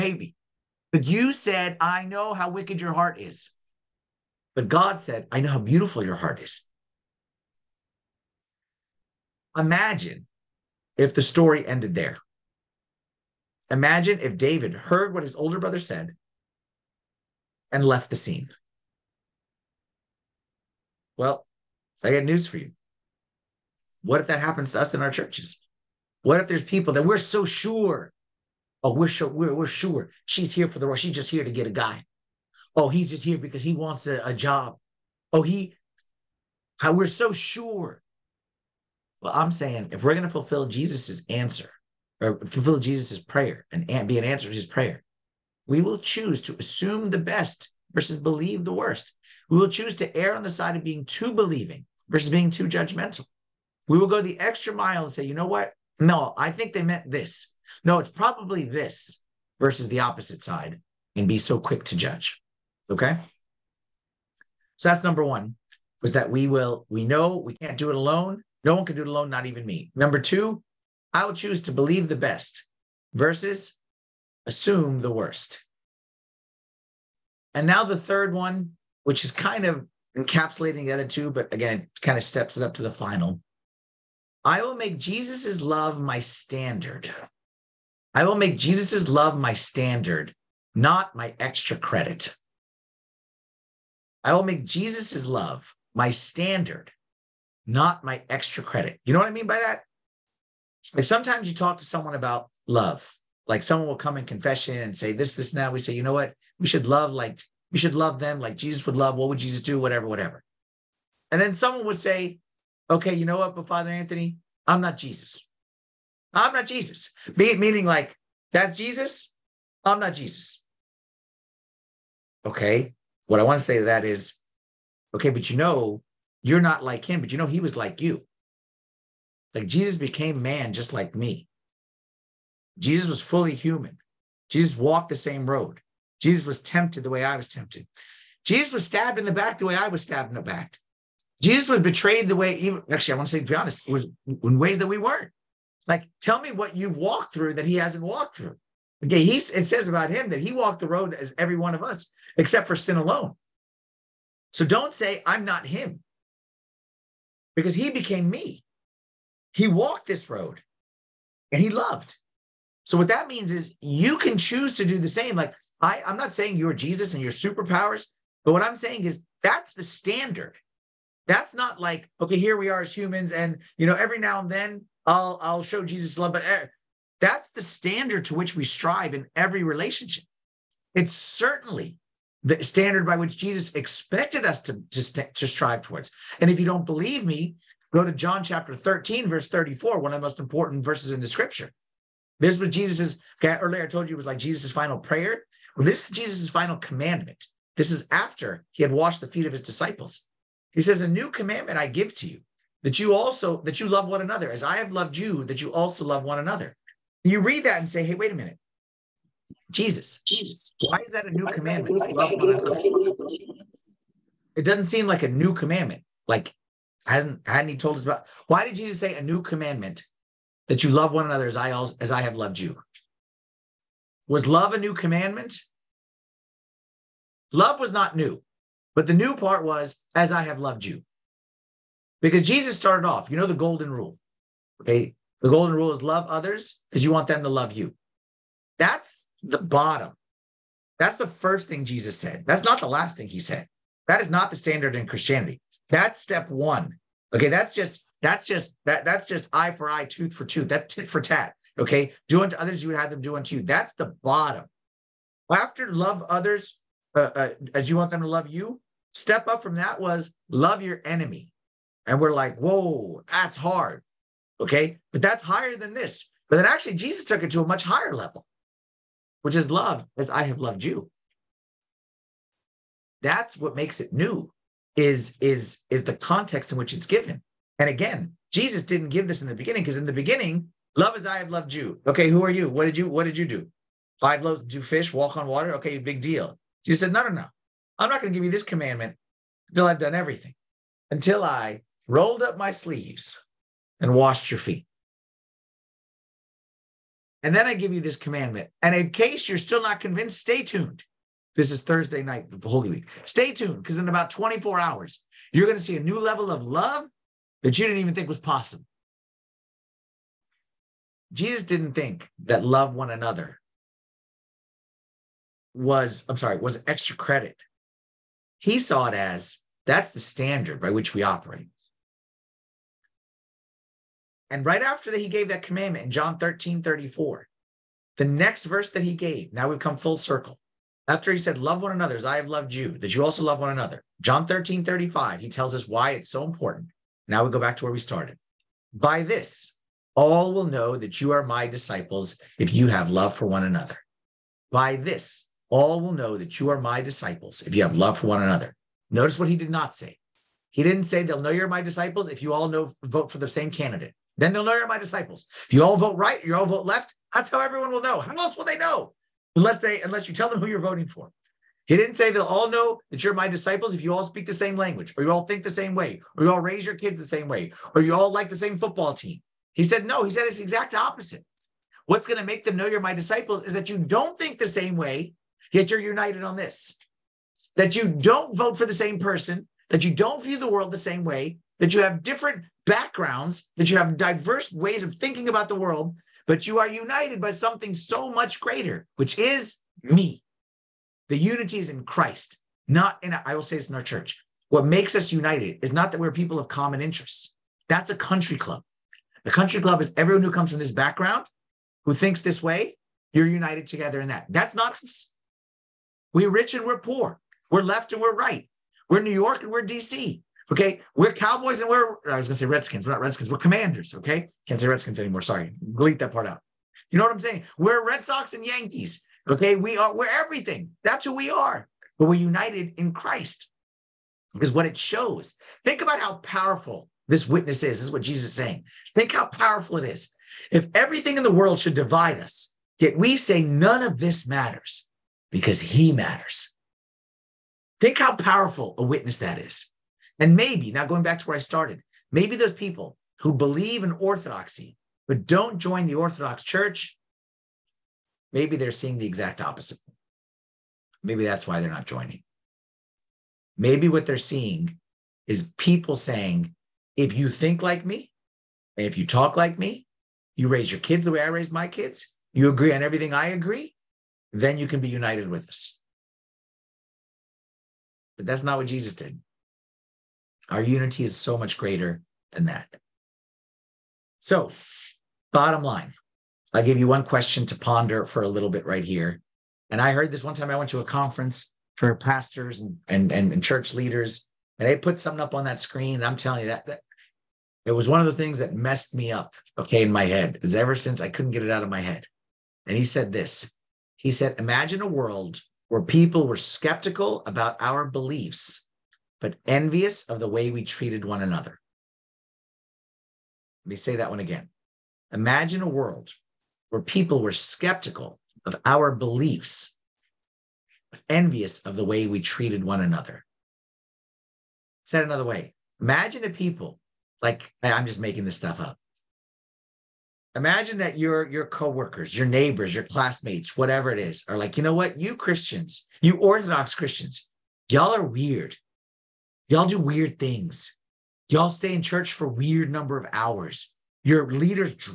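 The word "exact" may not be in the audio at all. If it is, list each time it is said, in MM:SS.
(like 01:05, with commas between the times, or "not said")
06:10, 07:29.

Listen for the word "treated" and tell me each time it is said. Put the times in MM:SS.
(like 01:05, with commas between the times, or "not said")
08:20, 08:32.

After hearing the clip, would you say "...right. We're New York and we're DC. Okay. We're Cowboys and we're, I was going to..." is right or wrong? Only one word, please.
right.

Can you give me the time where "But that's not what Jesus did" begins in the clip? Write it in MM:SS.
07:48.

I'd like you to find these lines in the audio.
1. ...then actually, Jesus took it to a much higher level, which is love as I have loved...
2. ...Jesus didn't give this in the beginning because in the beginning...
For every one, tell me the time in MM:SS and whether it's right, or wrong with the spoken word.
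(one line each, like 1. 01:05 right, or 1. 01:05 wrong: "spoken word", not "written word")
1. 04:26 right
2. 04:38 right.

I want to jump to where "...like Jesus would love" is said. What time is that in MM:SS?
01:48.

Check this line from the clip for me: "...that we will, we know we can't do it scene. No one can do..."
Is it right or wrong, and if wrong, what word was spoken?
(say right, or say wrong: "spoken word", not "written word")
wrong: "alone", not "scene".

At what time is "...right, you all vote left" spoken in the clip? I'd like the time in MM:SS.
05:56.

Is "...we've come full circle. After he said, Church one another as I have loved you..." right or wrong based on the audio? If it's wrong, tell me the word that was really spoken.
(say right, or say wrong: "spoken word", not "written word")
wrong: "Love", not "Church".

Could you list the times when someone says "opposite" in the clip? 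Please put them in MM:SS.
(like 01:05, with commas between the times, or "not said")
01:00, 06:10, 07:29.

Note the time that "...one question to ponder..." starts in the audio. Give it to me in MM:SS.
07:57.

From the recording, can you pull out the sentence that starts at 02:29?
Okay, he's, it says about him that he walked the road as every one of us, except for sin alone.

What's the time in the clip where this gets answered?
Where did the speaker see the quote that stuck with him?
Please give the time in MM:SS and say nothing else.
08:01.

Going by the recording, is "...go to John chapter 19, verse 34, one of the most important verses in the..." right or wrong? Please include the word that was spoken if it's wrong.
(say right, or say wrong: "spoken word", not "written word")
wrong: "13", not "19".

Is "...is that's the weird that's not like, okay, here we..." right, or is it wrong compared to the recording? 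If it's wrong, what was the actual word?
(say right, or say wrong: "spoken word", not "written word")
wrong: "standard", not "weird".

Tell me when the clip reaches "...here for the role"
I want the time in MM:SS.
00:30.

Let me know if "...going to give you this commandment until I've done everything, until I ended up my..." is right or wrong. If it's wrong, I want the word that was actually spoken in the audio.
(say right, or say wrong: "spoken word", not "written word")
wrong: "rolled", not "ended".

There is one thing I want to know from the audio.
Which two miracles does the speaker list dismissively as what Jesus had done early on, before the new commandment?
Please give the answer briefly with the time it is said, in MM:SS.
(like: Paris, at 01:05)
Five loaves two fish, walk on water, at 04:44.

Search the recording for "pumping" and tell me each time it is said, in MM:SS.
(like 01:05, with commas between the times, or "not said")
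not said.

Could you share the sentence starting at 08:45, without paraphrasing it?
You Christians, you Orthodox Christians, y'all are weird.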